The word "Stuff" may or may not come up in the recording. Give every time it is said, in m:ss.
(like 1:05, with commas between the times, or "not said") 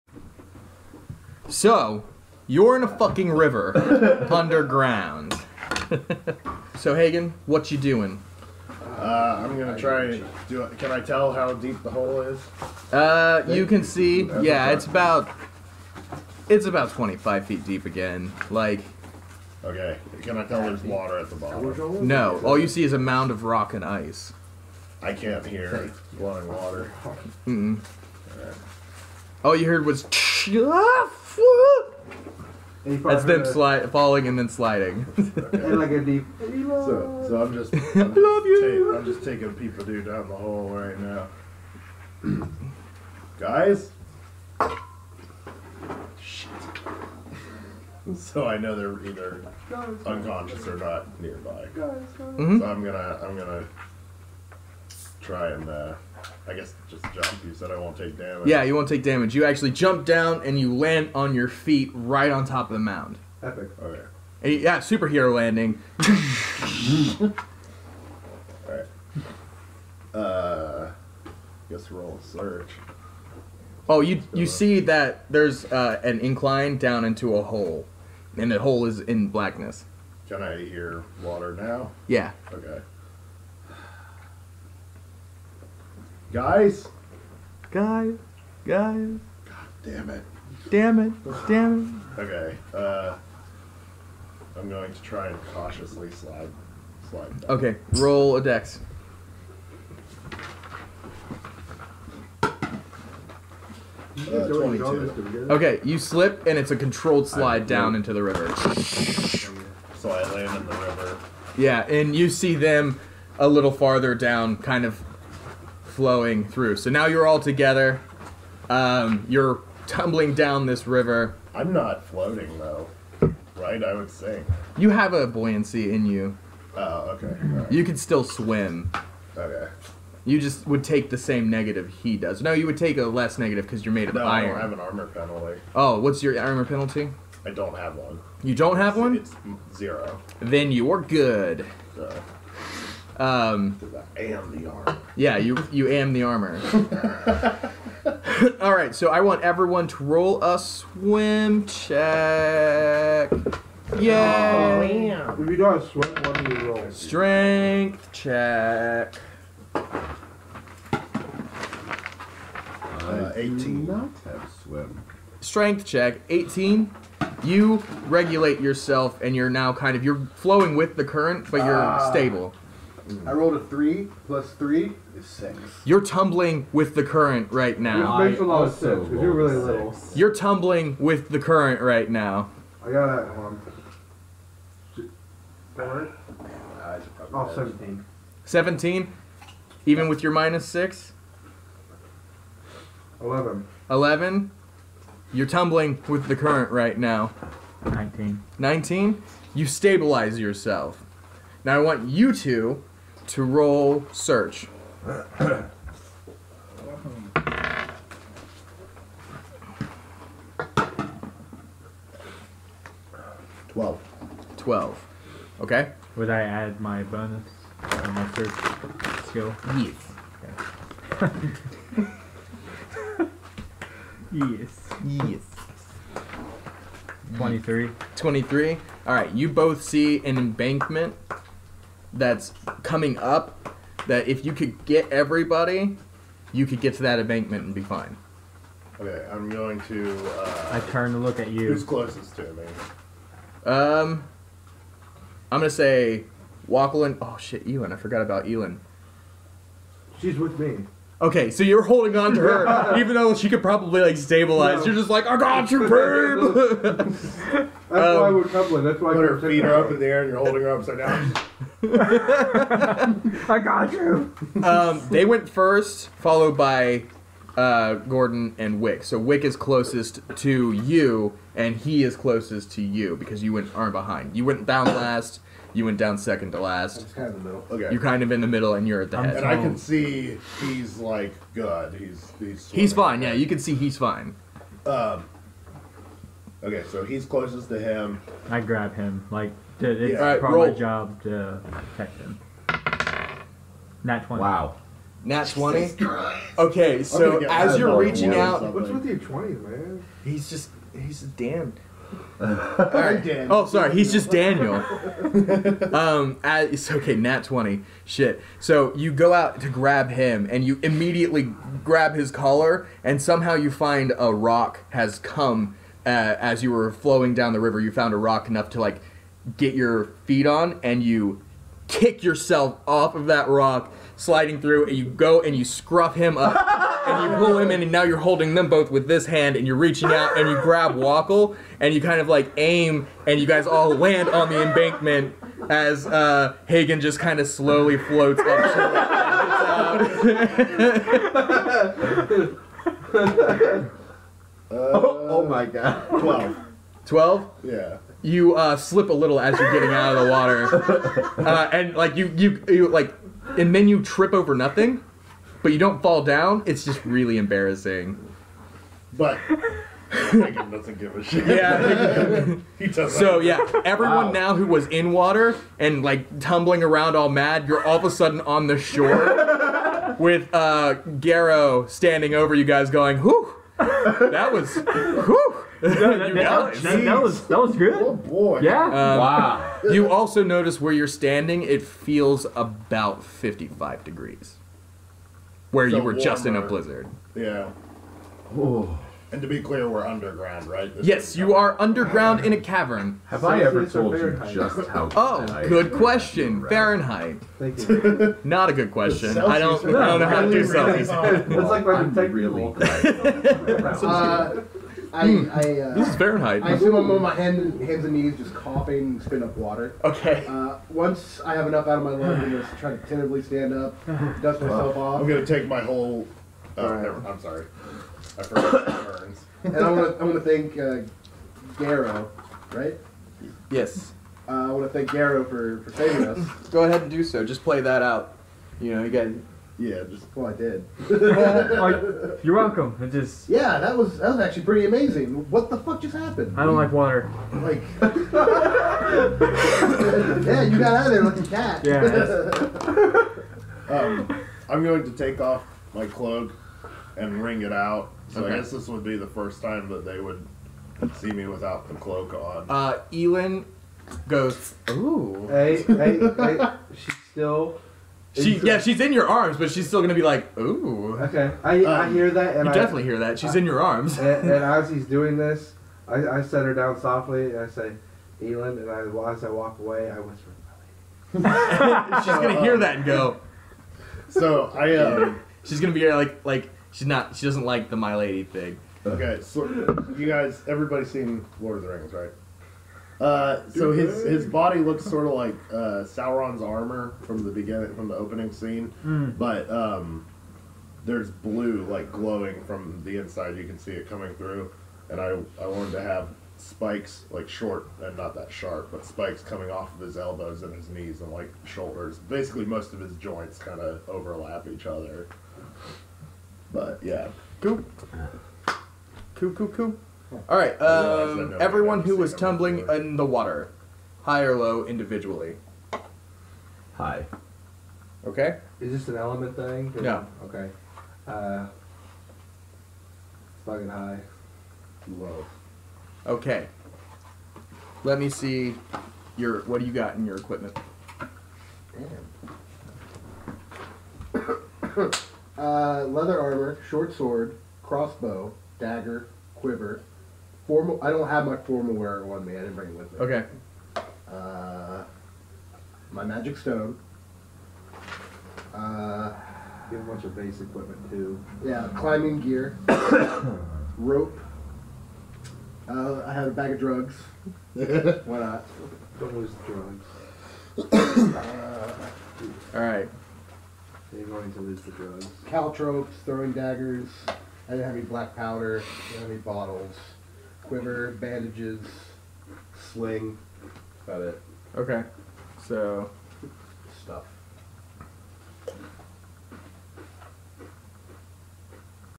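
9:37.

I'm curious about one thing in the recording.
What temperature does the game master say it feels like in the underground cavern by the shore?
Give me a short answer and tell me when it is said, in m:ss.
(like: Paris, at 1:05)
55 degrees Fahrenheit, at 6:23.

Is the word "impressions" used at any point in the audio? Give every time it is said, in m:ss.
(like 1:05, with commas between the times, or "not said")
not said.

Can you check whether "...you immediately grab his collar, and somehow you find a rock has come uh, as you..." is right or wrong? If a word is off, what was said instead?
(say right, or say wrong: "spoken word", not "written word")
right.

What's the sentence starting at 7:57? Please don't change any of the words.
She doesn't like the My Lady thing.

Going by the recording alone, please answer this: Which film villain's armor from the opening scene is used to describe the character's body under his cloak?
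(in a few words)
Sauron.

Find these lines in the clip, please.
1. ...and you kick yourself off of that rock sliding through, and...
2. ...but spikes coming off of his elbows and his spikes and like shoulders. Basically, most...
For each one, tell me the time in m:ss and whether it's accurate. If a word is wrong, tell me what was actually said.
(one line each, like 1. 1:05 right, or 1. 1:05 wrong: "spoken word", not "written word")
1. 5:20 right
2. 8:18 wrong: "knees", not "spikes".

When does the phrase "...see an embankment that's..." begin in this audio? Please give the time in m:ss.
3:49.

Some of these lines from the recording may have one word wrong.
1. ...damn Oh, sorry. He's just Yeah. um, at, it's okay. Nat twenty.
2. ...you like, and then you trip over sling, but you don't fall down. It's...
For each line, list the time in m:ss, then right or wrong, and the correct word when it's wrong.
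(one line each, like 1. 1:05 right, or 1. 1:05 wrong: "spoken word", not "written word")
1. 5:01 wrong: "Daniel", not "Yeah"
2. 5:52 wrong: "nothing", not "sling".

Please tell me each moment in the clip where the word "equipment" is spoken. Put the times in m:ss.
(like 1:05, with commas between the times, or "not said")
8:50, 9:10.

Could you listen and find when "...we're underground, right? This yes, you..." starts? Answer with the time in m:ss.
6:29.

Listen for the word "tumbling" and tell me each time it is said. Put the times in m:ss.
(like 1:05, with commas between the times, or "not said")
1:59, 2:56, 3:00, 3:15, 6:06, 8:32.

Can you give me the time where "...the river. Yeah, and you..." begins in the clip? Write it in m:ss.
1:50.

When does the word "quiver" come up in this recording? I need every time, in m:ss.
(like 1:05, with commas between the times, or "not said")
8:59, 9:30.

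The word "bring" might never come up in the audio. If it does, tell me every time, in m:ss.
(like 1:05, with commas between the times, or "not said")
9:02.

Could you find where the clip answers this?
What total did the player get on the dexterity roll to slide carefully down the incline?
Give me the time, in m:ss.
1:44.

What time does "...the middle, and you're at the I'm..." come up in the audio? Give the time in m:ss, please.
4:38.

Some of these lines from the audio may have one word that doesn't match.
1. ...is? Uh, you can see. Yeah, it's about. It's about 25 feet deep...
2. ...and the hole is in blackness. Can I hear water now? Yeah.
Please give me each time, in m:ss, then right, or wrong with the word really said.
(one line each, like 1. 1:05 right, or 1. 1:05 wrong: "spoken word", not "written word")
1. 0:12 right
2. 1:18 right.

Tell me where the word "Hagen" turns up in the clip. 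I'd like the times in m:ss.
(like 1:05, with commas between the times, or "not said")
0:06, 5:36.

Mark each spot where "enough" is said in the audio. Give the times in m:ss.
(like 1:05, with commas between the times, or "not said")
5:18, 6:51.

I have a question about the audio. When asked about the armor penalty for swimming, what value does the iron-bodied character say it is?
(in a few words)
zero.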